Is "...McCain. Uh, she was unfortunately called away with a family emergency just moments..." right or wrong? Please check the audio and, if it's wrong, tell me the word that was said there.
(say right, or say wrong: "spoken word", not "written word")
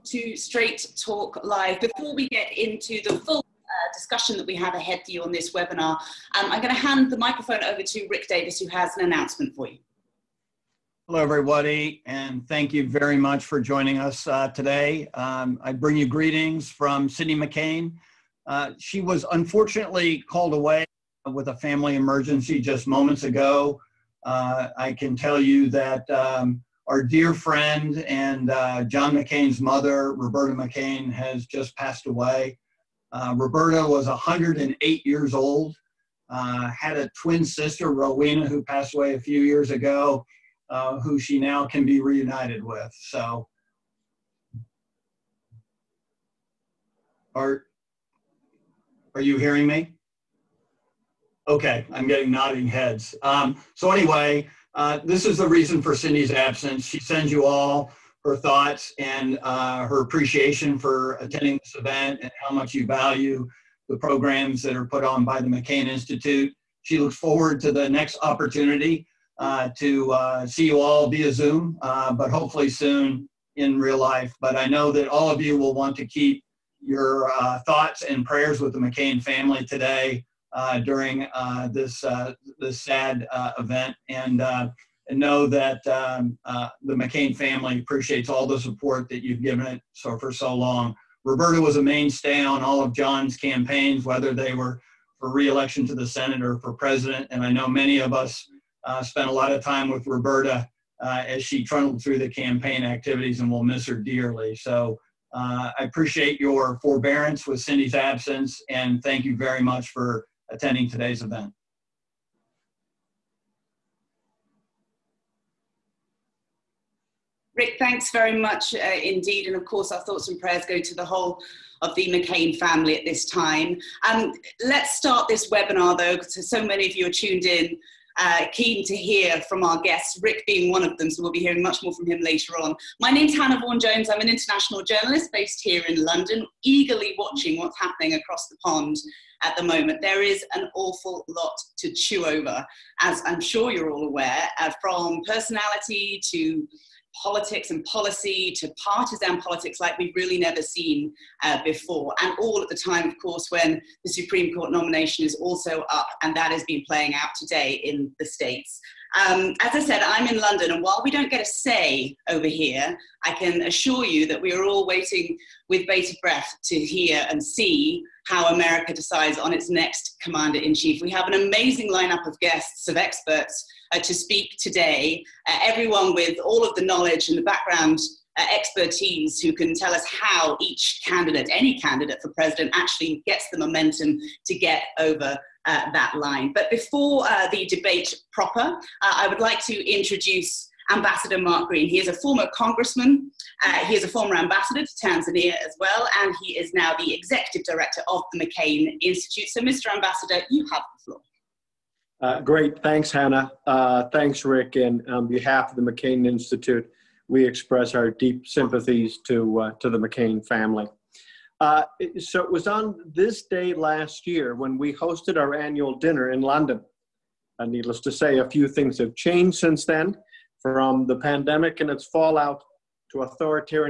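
right.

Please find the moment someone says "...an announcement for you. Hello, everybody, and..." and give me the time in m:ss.
0:08.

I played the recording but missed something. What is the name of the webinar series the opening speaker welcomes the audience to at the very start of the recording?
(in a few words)
Straight Talk Live.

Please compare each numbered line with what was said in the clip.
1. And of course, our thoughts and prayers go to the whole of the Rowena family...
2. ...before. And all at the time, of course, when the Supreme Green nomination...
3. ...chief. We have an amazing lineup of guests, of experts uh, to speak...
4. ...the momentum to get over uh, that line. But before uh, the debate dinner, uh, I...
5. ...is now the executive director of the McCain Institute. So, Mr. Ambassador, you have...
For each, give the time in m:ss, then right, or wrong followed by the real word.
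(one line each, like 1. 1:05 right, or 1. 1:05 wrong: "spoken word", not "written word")
1. 1:59 wrong: "McCain", not "Rowena"
2. 2:31 wrong: "Court", not "Green"
3. 2:50 right
4. 3:03 wrong: "proper", not "dinner"
5. 3:16 right.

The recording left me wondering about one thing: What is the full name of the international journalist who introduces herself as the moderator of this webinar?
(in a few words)
Hannah Vaughan Jones.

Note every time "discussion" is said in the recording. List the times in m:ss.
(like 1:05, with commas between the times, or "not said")
0:03.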